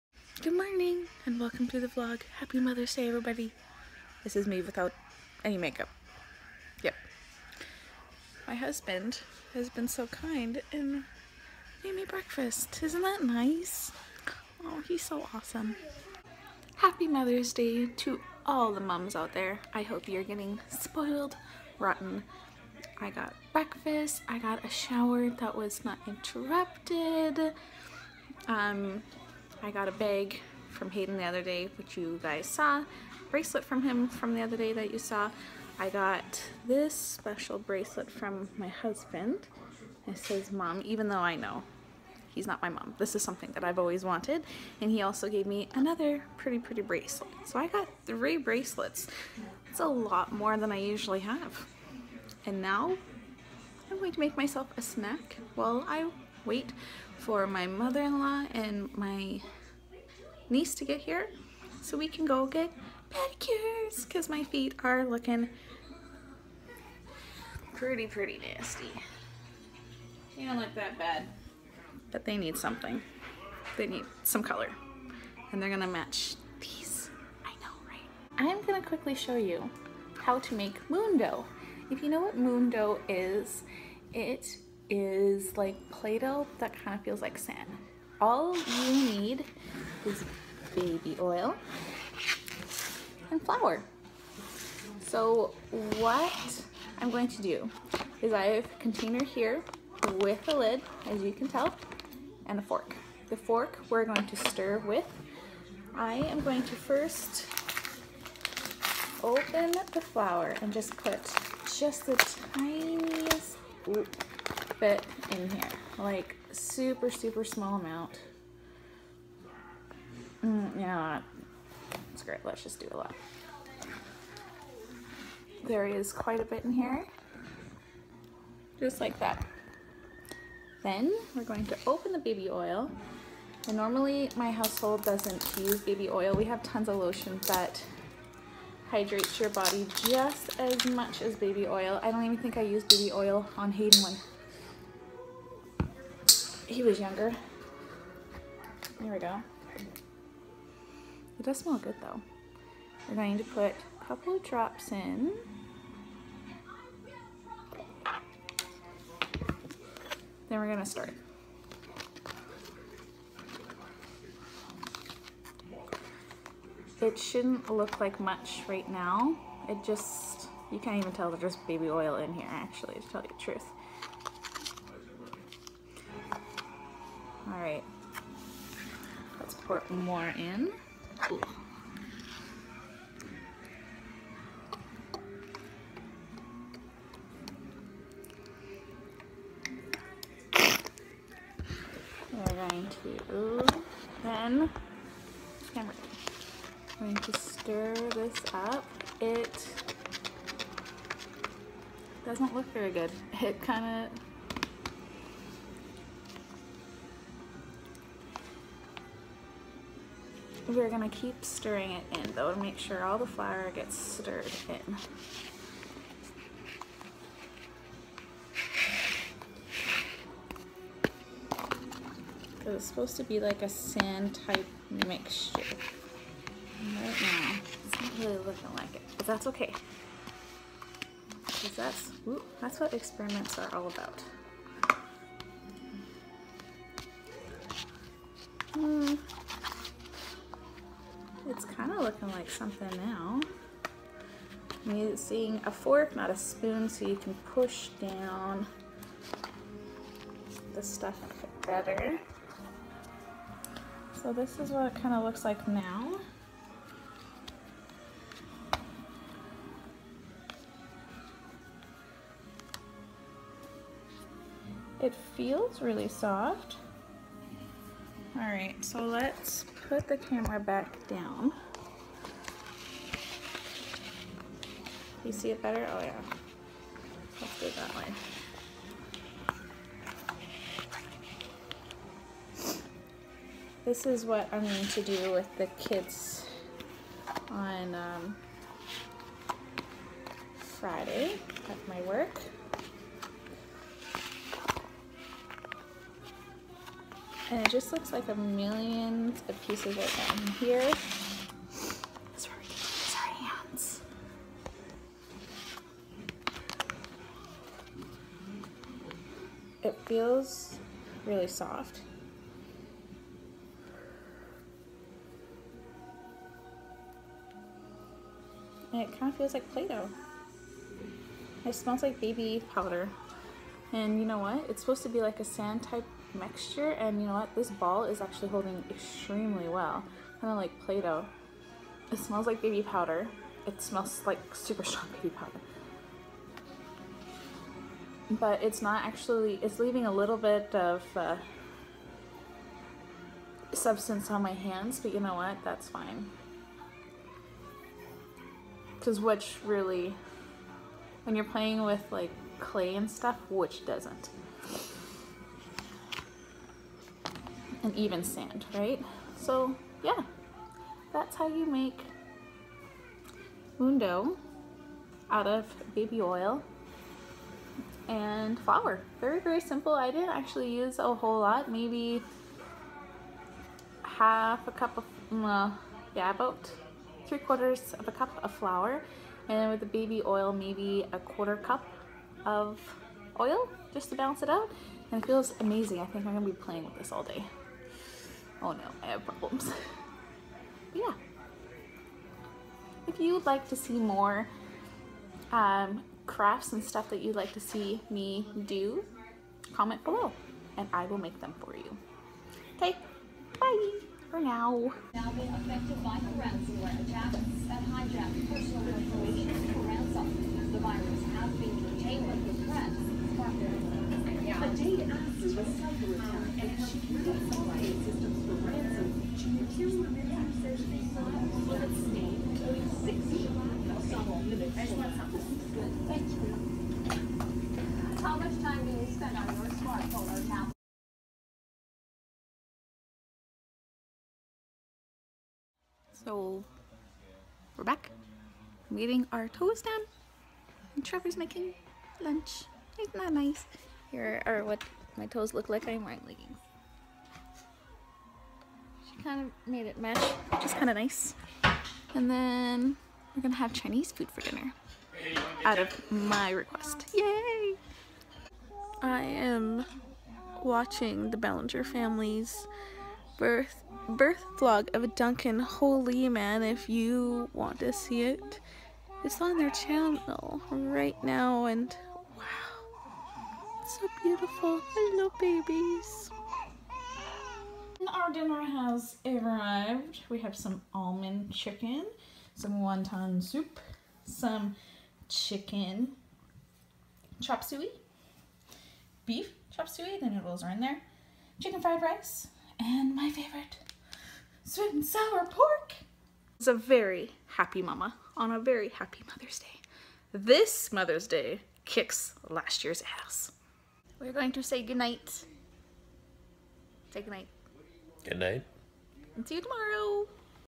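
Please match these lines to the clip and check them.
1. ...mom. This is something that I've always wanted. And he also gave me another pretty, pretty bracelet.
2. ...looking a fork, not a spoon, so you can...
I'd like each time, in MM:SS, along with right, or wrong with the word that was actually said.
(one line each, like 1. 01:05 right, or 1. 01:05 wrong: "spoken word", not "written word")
1. 00:42 right
2. 04:04 wrong: "using", not "looking".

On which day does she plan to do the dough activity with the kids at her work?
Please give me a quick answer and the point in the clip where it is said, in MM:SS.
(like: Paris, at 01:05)
Friday, at 04:50.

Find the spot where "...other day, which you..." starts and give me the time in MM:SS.
00:31.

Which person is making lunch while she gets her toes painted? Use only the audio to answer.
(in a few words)
Trevor.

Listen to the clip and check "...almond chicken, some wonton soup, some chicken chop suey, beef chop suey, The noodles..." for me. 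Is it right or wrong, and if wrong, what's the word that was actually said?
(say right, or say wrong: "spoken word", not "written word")
right.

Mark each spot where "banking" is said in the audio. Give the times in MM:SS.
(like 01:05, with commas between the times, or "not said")
not said.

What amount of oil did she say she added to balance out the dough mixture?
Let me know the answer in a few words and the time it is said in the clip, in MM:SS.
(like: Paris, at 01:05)
1/4 cup, at 06:21.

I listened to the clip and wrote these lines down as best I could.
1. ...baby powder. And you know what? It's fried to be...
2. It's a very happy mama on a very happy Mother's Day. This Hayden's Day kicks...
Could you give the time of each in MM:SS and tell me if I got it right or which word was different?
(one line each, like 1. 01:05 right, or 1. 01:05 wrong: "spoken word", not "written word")
1. 05:22 wrong: "supposed", not "fried"
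2. 08:16 wrong: "Mother", not "Hayden".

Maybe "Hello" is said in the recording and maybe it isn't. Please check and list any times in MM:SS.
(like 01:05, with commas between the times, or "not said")
07:54.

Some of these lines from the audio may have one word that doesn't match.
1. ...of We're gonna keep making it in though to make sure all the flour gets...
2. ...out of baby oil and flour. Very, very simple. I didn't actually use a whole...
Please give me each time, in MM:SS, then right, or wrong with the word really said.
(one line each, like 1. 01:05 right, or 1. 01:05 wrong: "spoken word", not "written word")
1. 03:24 wrong: "stirring", not "making"
2. 06:05 right.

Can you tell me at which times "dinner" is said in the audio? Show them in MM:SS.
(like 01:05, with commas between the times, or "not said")
07:34, 07:58.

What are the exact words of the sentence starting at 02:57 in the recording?
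All right, let's pour more in.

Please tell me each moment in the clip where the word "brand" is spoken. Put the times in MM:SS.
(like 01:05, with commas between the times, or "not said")
not said.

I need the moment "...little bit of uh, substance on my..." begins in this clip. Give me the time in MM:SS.
05:40.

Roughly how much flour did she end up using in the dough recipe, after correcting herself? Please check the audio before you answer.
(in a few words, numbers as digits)
3/4 cup.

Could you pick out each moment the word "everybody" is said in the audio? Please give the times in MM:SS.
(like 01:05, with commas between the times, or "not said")
00:03.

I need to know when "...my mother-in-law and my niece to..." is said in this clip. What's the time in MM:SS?
00:57.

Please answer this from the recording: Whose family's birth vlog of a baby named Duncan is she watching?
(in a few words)
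the Bellinger family.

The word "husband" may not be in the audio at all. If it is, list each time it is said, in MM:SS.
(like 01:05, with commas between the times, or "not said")
00:08, 00:38.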